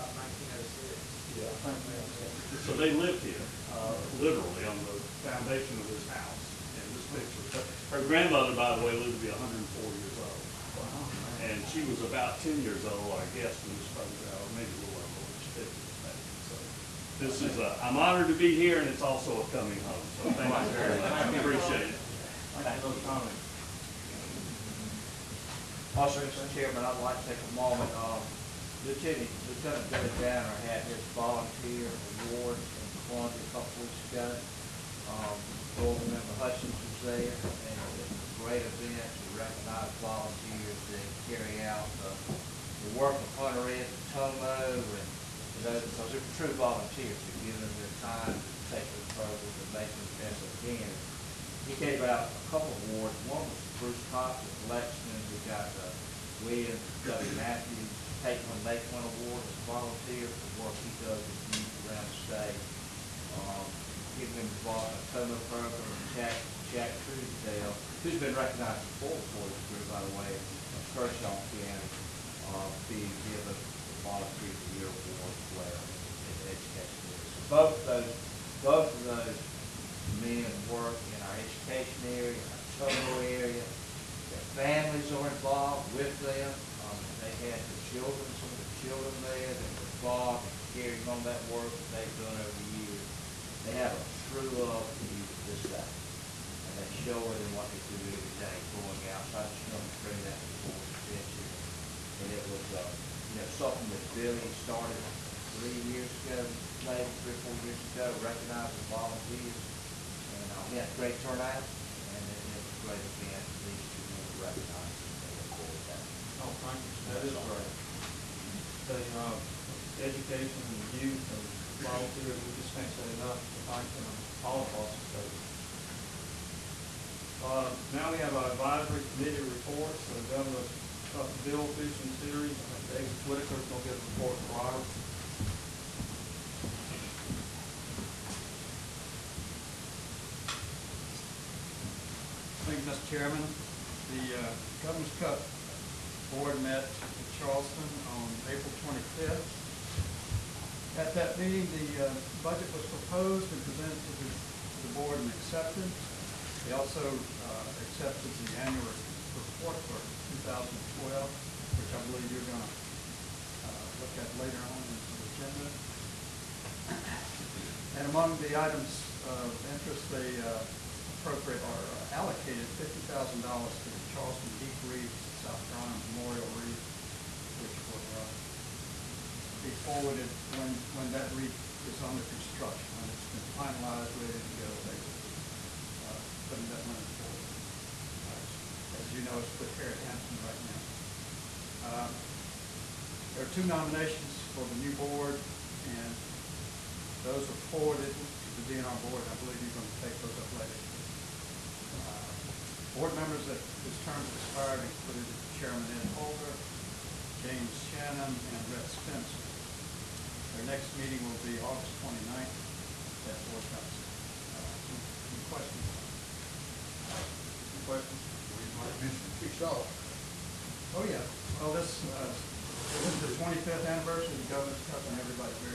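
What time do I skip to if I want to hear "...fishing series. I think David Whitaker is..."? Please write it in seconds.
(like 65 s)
131 s.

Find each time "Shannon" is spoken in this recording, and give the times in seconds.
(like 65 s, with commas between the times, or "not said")
207 s.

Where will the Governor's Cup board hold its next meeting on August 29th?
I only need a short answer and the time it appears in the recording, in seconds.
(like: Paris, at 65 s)
Fort Johnson, at 213 s.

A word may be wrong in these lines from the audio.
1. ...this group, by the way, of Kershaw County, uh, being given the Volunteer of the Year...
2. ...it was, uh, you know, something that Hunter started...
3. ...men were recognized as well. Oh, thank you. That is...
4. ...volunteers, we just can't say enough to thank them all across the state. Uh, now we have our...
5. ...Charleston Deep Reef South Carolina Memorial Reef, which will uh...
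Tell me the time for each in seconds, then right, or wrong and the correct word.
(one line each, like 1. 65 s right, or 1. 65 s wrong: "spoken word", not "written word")
1. 69 s right
2. 102 s wrong: "Billy", not "Hunter"
3. 114 s right
4. 121 s right
5. 174 s right.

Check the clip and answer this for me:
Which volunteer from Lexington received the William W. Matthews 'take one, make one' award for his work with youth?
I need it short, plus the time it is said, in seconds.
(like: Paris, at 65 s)
Bruce Cox, at 53 s.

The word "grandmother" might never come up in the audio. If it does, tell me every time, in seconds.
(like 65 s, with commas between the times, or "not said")
8 s.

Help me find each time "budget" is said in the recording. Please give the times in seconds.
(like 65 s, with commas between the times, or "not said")
152 s.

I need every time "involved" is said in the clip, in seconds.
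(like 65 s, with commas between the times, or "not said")
64 s, 85 s, 89 s.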